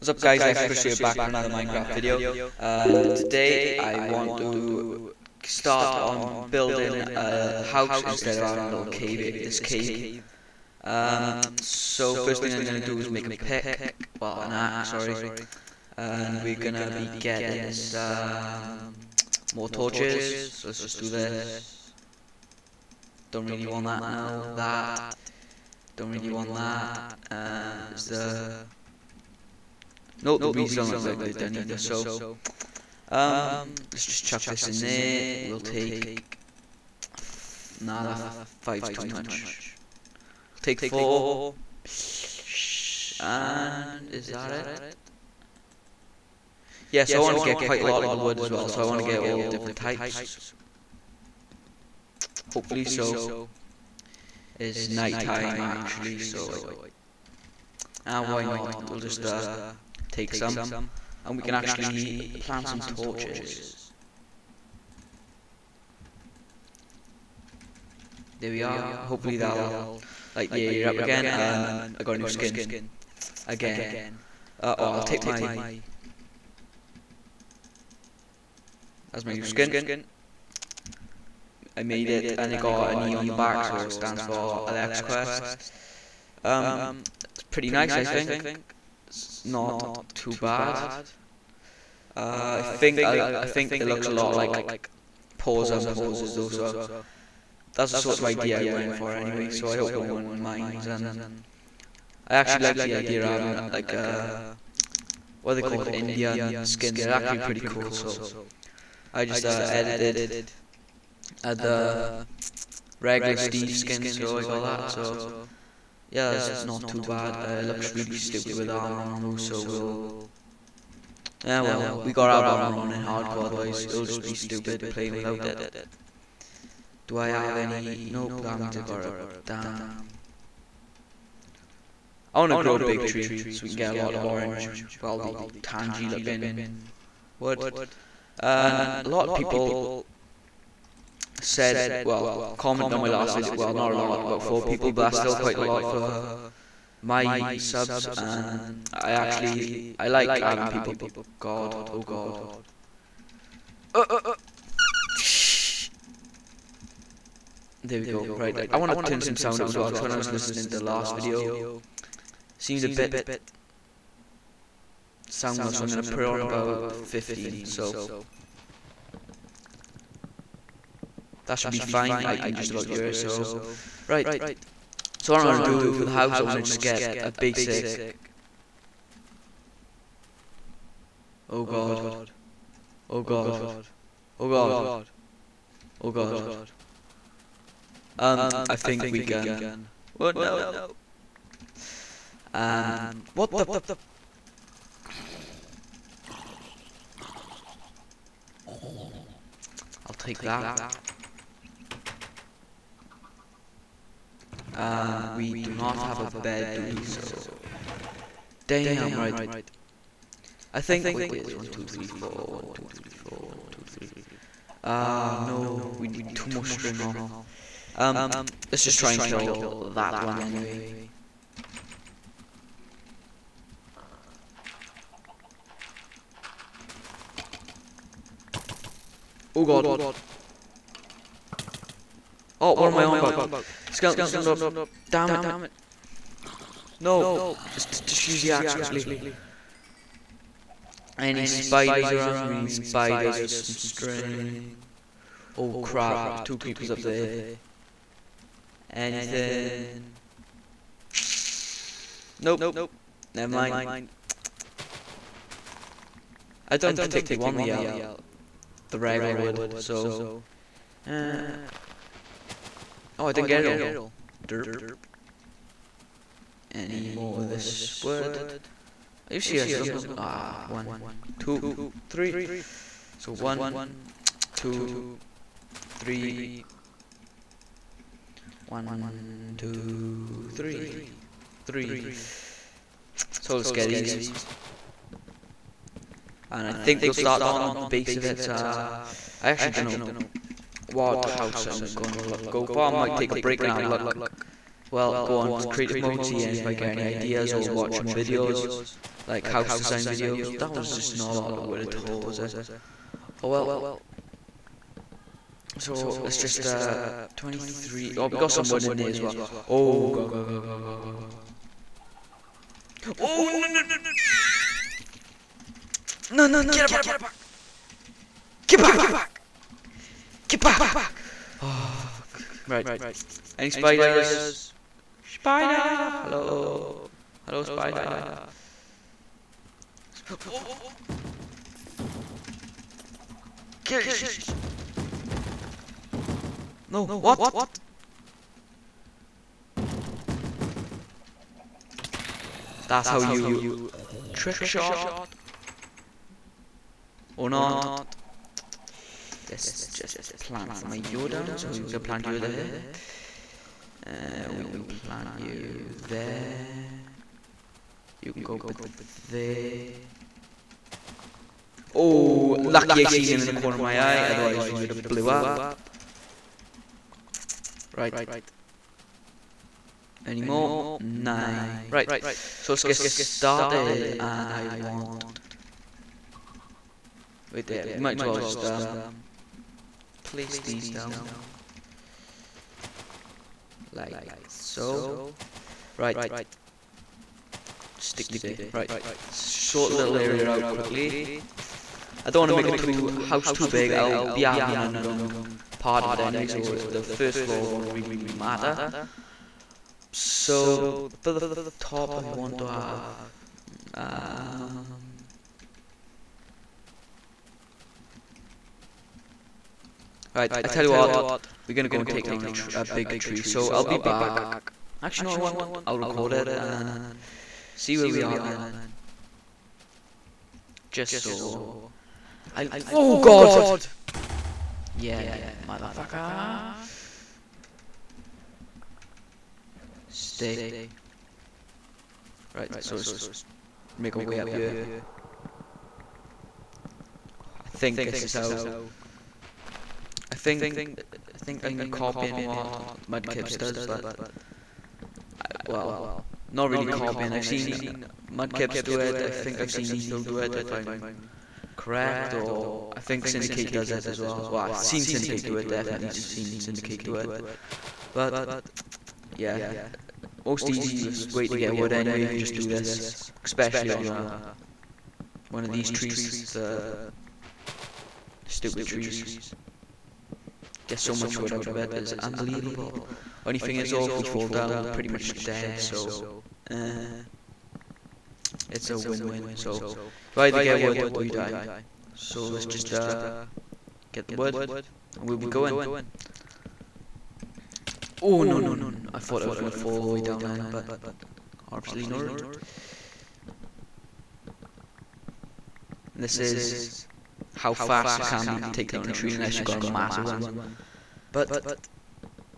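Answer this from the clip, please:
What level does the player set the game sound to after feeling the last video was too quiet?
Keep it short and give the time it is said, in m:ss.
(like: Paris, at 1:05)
15, at 2:46.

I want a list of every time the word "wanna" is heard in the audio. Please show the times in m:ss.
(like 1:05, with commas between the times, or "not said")
2:12.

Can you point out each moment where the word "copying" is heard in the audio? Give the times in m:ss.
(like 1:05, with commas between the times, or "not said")
7:21, 7:26.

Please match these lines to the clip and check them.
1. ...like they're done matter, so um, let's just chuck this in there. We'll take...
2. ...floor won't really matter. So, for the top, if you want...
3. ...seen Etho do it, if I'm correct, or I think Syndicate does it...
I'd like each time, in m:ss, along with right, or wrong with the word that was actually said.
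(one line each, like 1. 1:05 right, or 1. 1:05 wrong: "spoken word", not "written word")
1. 0:31 wrong: "either", not "matter"
2. 6:37 right
3. 7:29 right.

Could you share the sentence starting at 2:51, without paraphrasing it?
that should be fine I can just about it.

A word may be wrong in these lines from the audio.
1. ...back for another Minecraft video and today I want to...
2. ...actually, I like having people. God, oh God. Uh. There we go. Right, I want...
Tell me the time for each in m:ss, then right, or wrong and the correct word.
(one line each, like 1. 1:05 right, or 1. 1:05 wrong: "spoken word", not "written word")
1. 0:00 right
2. 2:29 right.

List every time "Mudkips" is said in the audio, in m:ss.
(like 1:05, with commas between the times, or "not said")
7:23, 7:28.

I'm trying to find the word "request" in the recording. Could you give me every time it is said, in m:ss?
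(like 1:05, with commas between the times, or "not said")
not said.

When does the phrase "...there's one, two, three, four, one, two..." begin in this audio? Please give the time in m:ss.
3:31.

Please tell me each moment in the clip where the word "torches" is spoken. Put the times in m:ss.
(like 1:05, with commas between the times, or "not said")
0:19, 1:02.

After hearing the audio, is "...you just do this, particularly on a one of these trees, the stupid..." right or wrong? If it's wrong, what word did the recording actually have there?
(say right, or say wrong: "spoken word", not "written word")
wrong: "especially", not "particularly".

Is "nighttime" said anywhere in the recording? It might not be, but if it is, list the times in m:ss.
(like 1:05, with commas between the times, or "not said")
0:54.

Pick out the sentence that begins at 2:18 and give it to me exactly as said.
And a lot of people said, well, comment on my last video.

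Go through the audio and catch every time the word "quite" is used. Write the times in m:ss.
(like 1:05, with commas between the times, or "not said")
0:47, 2:25.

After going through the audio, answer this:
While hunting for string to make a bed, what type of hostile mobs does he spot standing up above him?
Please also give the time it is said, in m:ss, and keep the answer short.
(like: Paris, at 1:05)
creepers, at 4:06.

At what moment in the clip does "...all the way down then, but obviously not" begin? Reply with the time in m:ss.
8:09.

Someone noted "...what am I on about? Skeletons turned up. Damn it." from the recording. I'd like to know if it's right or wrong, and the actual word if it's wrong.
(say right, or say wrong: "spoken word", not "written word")
right.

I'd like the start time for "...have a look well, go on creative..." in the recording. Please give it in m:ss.
4:53.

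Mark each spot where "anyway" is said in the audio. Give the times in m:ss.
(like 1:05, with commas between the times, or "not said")
1:39, 3:40, 6:36, 7:41.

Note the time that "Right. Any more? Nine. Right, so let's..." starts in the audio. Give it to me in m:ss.
6:07.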